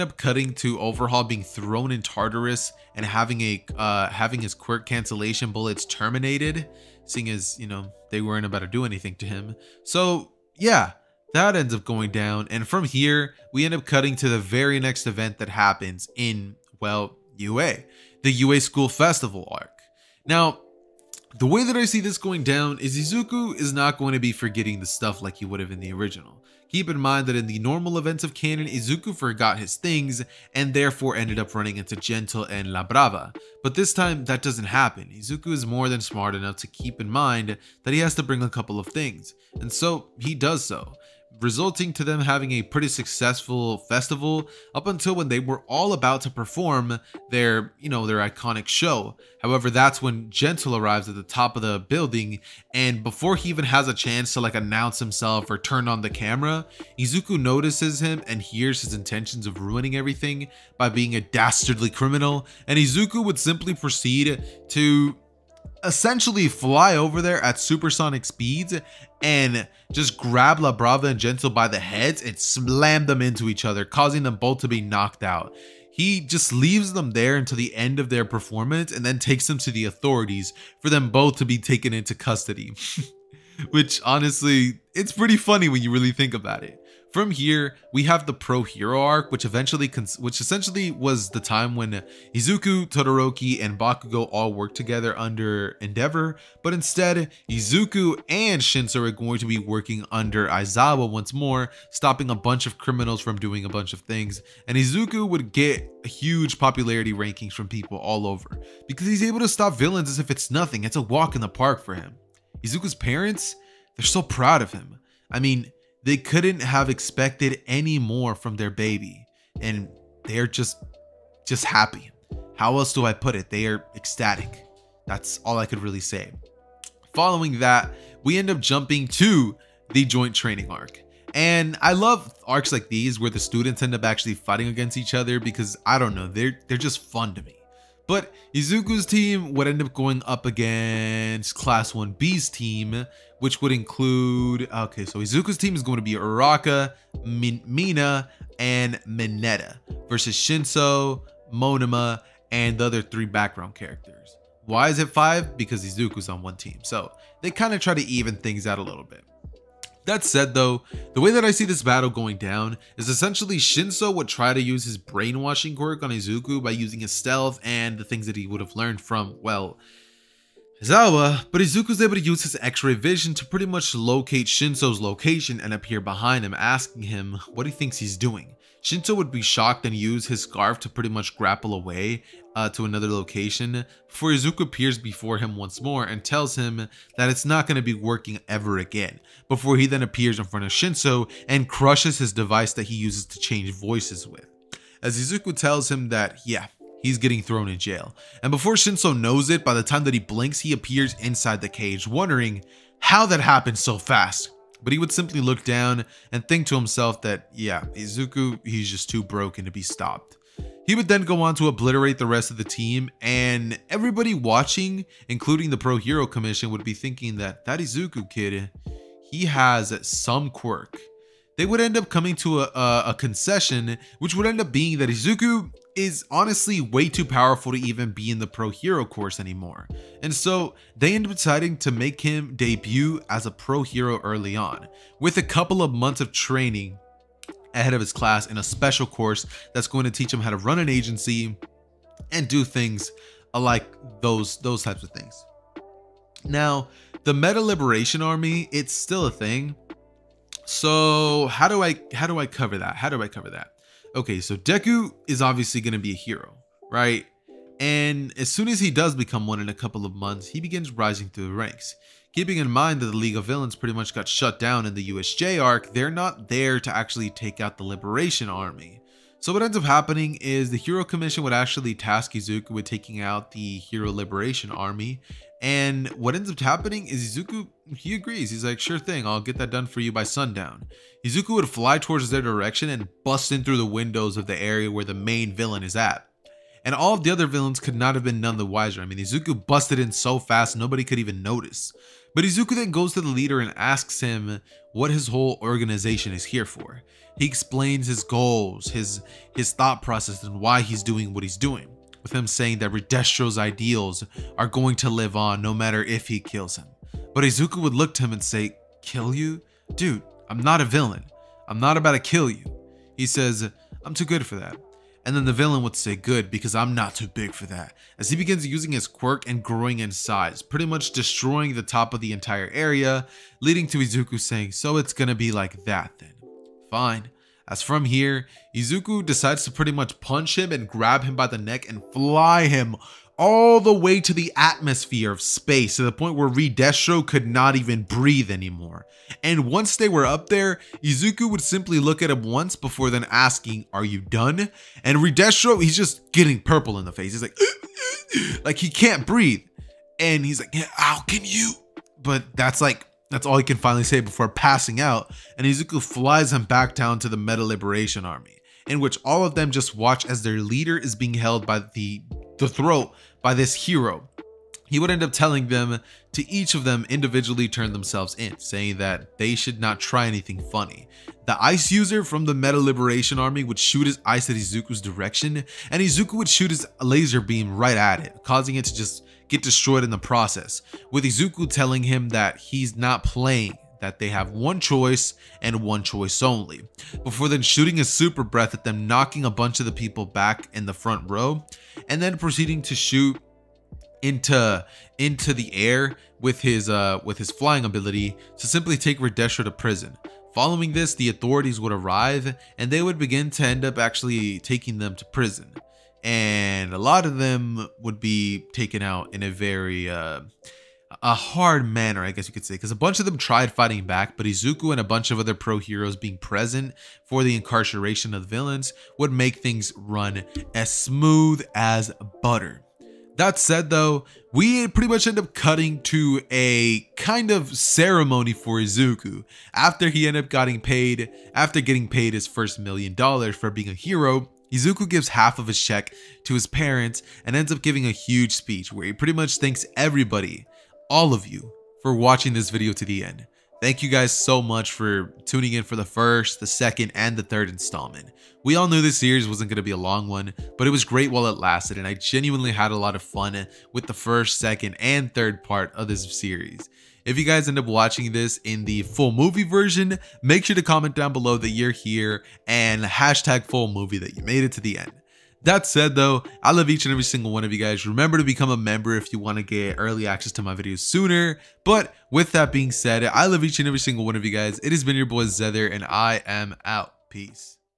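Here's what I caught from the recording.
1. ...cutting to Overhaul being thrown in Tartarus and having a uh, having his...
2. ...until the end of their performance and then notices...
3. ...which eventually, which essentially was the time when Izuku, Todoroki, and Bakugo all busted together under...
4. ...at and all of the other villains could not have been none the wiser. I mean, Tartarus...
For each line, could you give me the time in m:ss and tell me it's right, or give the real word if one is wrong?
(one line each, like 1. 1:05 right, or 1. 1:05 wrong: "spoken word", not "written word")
1. 0:00 right
2. 1:17 wrong: "takes", not "notices"
3. 1:29 wrong: "worked", not "busted"
4. 4:45 wrong: "Izuku", not "Tartarus".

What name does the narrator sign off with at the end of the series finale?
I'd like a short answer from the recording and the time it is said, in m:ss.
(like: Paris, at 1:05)
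Xehther, at 7:55.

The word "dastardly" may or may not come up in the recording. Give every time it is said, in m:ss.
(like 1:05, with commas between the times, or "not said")
1:01.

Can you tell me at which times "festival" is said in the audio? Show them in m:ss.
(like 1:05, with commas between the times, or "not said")
0:18, 0:43.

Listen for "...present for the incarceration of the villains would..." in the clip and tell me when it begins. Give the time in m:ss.
6:56.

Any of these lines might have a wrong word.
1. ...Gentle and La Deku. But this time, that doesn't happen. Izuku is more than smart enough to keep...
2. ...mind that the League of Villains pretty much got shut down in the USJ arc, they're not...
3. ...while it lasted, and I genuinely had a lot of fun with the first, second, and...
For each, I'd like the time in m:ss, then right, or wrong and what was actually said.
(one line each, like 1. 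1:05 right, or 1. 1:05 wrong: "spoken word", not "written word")
1. 0:31 wrong: "Brava", not "Deku"
2. 4:22 right
3. 7:31 right.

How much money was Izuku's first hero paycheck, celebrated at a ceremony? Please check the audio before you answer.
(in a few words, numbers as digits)
1 million dollars.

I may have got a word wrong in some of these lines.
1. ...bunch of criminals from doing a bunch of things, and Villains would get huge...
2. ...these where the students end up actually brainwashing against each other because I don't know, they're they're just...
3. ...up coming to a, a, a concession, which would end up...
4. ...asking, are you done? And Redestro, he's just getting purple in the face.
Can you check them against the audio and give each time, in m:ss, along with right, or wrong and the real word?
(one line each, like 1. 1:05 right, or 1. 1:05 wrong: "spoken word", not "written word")
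1. 1:42 wrong: "Izuku", not "Villains"
2. 2:12 wrong: "fighting", not "brainwashing"
3. 3:41 right
4. 5:43 right.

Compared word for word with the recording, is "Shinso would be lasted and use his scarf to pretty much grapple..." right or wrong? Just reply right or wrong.
wrong.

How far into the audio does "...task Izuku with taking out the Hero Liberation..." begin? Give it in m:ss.
4:31.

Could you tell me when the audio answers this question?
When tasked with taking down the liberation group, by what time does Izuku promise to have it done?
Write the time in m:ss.
4:40.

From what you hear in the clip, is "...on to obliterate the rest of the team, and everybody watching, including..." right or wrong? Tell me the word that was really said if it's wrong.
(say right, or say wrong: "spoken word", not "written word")
right.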